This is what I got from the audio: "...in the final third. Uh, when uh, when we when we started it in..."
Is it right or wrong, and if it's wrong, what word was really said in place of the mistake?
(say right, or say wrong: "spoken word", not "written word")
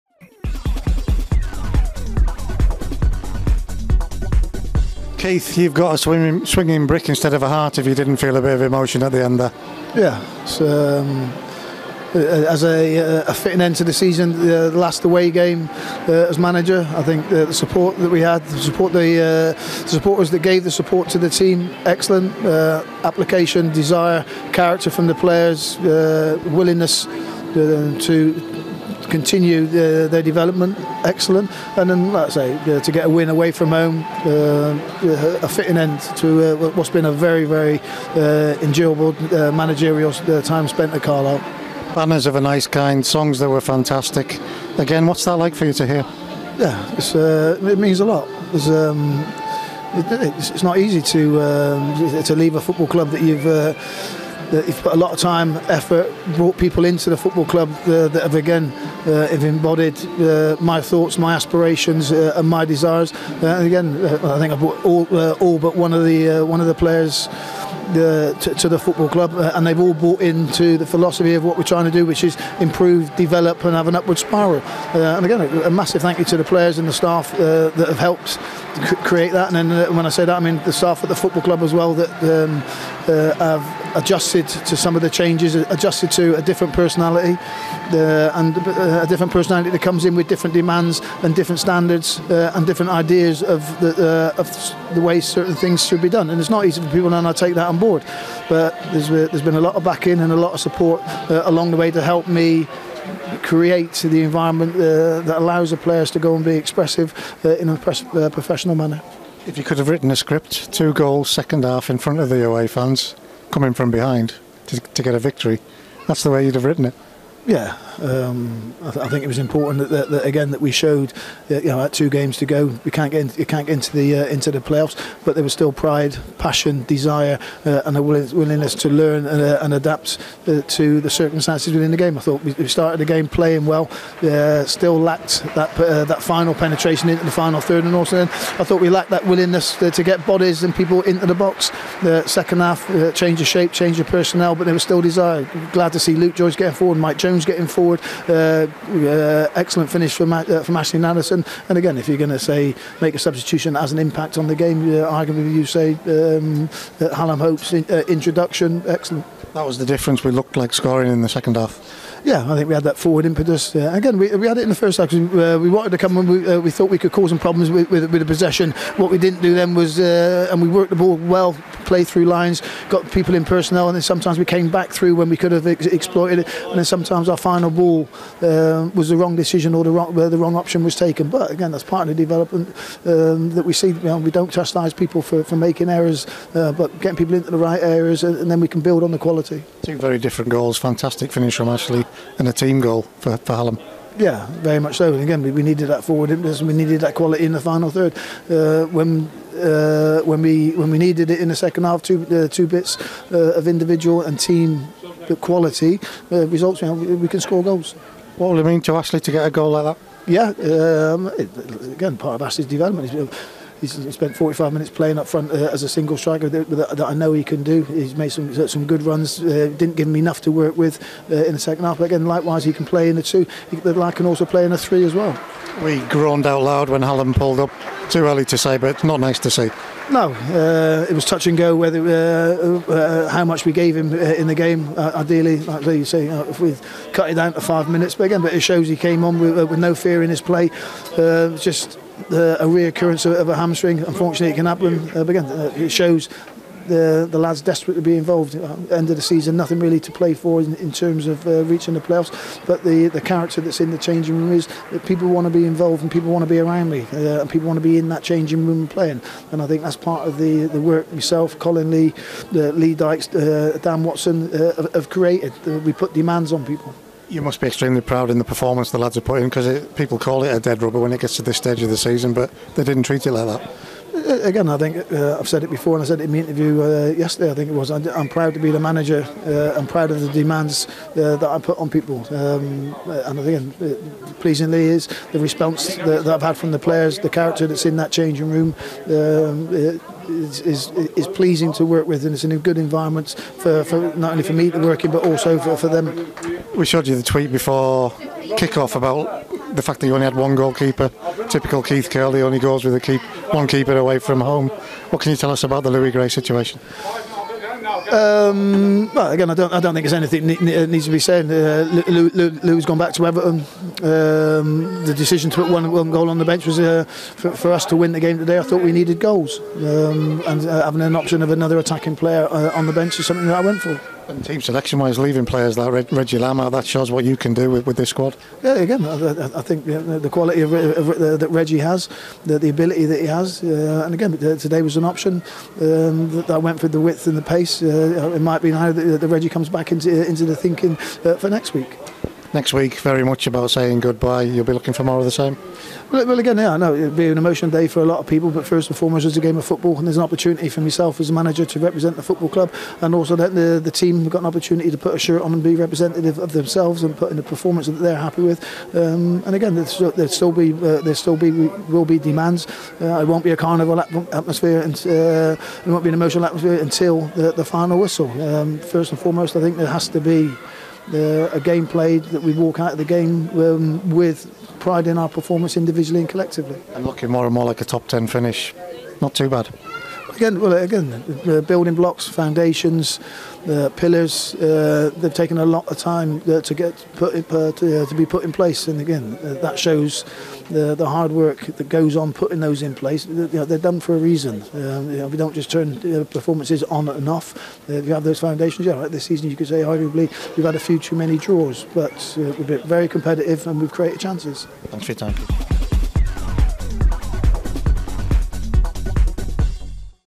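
wrong: "needed", not "started".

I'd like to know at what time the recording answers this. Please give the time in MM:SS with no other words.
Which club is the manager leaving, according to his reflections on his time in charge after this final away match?
00:41.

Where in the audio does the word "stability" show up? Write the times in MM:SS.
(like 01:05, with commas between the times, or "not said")
not said.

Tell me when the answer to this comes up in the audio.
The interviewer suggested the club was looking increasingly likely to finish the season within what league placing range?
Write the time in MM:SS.
06:17.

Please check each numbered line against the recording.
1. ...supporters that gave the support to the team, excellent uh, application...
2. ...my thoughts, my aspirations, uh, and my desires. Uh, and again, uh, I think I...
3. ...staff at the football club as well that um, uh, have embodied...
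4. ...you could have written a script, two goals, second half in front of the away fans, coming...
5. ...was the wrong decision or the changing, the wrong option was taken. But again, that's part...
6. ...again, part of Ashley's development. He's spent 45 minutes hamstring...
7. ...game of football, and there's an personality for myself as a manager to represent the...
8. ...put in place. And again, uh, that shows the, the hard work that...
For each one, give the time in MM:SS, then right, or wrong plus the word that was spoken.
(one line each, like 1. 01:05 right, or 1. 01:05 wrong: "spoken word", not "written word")
1. 00:19 right
2. 01:00 right
3. 01:20 wrong: "adjusted", not "embodied"
4. 01:49 right
5. 02:58 wrong: "wrong", not "changing"
6. 03:31 wrong: "playing", not "hamstring"
7. 05:49 wrong: "opportunity", not "personality"
8. 06:28 right.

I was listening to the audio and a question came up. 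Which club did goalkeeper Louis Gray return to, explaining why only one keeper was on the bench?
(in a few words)
Everton.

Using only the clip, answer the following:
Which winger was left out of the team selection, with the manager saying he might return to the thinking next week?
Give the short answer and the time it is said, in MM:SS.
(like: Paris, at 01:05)
Reggie Lambe, at 05:26.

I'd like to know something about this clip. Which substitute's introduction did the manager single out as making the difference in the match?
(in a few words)
Hallam Hope.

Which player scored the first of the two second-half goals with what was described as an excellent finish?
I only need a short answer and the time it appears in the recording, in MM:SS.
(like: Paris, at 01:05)
Ashley Nadesan, at 02:30.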